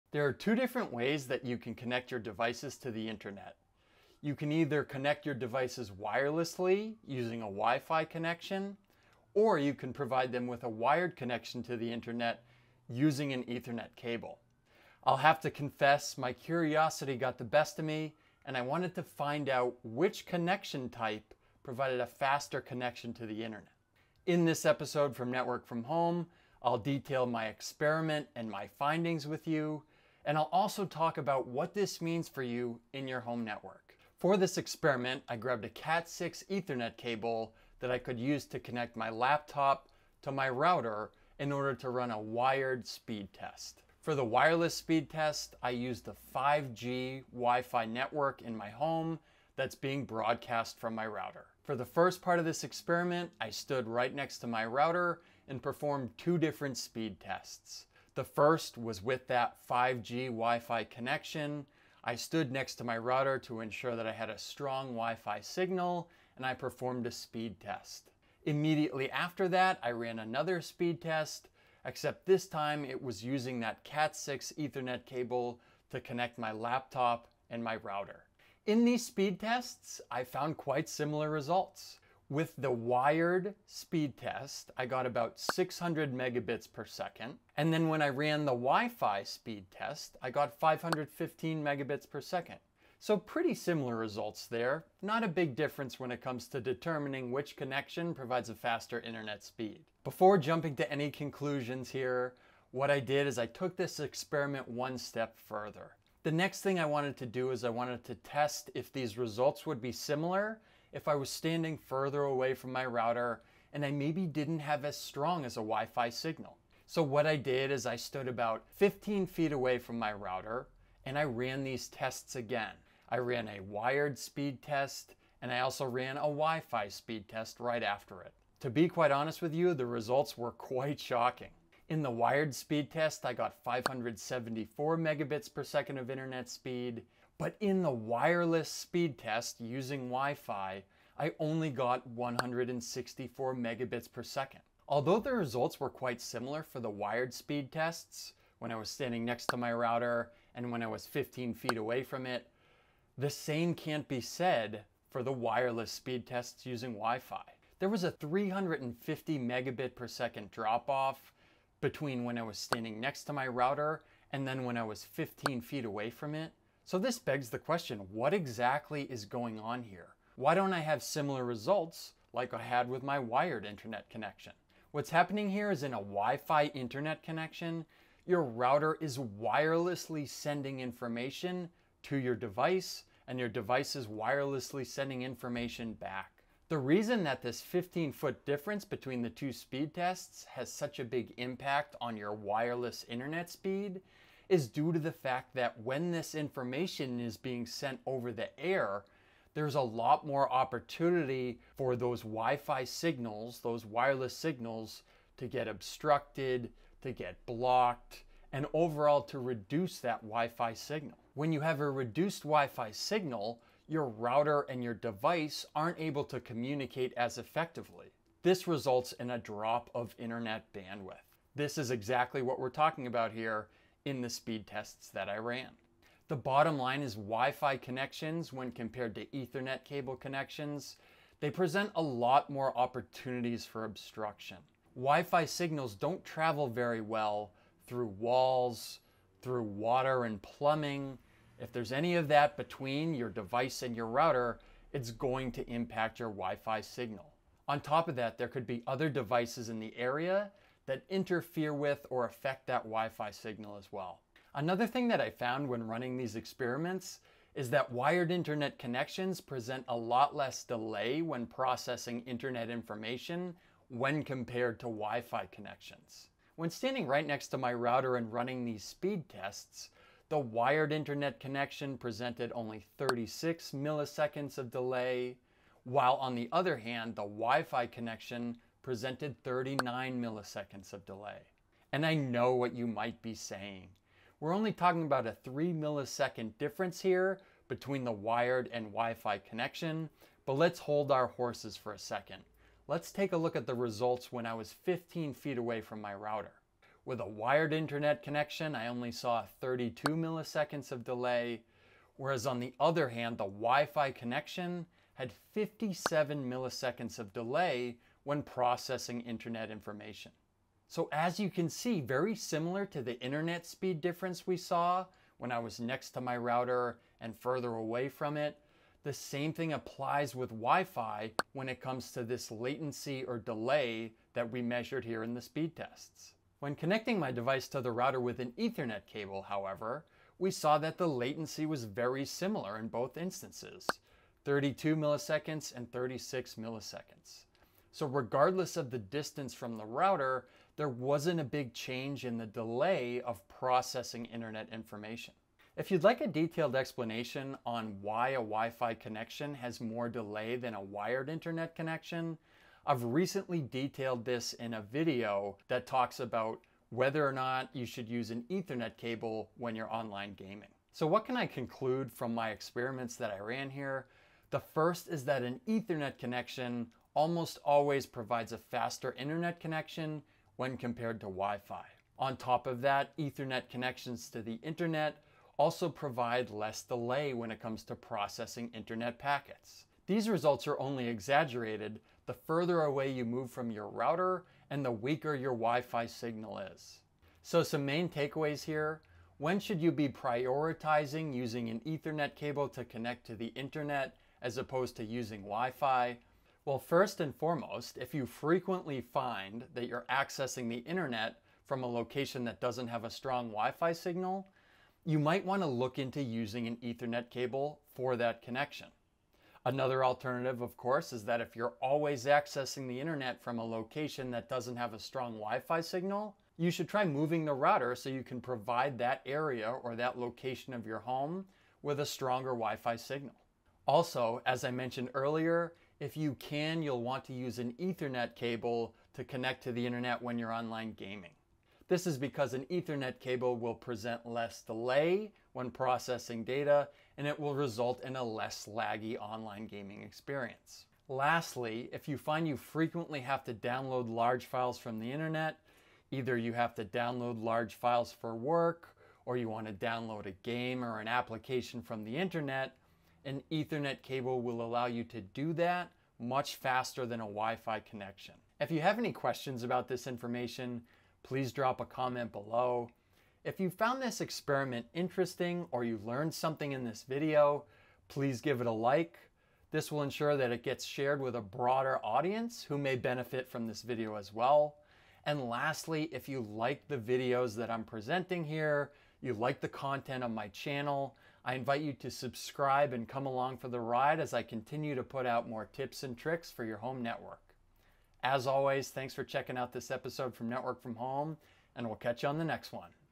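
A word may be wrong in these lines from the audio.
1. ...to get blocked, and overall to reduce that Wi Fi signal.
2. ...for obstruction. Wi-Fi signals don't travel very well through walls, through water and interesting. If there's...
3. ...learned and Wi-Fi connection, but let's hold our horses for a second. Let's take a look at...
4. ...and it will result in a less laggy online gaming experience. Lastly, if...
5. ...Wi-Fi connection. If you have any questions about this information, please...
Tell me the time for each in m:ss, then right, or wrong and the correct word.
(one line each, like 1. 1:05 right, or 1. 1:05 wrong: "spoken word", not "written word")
1. 3:27 right
2. 3:53 wrong: "plumbing", not "interesting"
3. 4:48 wrong: "wired", not "learned"
4. 7:17 right
5. 7:37 right.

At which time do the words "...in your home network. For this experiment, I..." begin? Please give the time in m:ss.
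0:32.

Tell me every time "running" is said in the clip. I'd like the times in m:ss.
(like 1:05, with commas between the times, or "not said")
4:15, 4:28.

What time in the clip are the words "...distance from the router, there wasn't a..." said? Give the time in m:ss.
5:38.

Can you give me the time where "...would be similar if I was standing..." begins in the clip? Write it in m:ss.
1:49.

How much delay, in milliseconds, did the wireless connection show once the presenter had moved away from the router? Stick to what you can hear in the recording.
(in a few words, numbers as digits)
57 milliseconds.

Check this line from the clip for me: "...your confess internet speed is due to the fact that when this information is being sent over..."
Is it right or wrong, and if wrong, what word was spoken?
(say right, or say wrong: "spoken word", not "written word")
wrong: "wireless", not "confess".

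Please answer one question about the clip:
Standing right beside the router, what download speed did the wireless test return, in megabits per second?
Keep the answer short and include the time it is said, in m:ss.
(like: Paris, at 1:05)
515, at 1:30.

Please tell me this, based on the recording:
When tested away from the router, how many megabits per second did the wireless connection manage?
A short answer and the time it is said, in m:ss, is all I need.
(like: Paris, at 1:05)
164, at 2:22.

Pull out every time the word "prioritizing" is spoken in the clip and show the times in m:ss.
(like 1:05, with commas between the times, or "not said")
6:30.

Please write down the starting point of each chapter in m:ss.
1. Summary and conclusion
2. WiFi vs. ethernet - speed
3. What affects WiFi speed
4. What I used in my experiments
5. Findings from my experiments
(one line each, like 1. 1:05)
1. 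7:39
2. 0:52
3. 2:55
4. 0:34
5. 6:01.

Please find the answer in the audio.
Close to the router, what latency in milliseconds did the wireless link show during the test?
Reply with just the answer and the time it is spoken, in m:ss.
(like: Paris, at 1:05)
39 milliseconds, at 4:39.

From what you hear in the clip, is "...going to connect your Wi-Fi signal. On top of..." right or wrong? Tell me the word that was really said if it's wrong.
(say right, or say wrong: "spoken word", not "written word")
wrong: "impact", not "connect".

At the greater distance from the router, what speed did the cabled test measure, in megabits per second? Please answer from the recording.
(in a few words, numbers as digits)
574.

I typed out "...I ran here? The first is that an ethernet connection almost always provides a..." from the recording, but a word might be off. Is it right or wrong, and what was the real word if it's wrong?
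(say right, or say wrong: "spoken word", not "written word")
right.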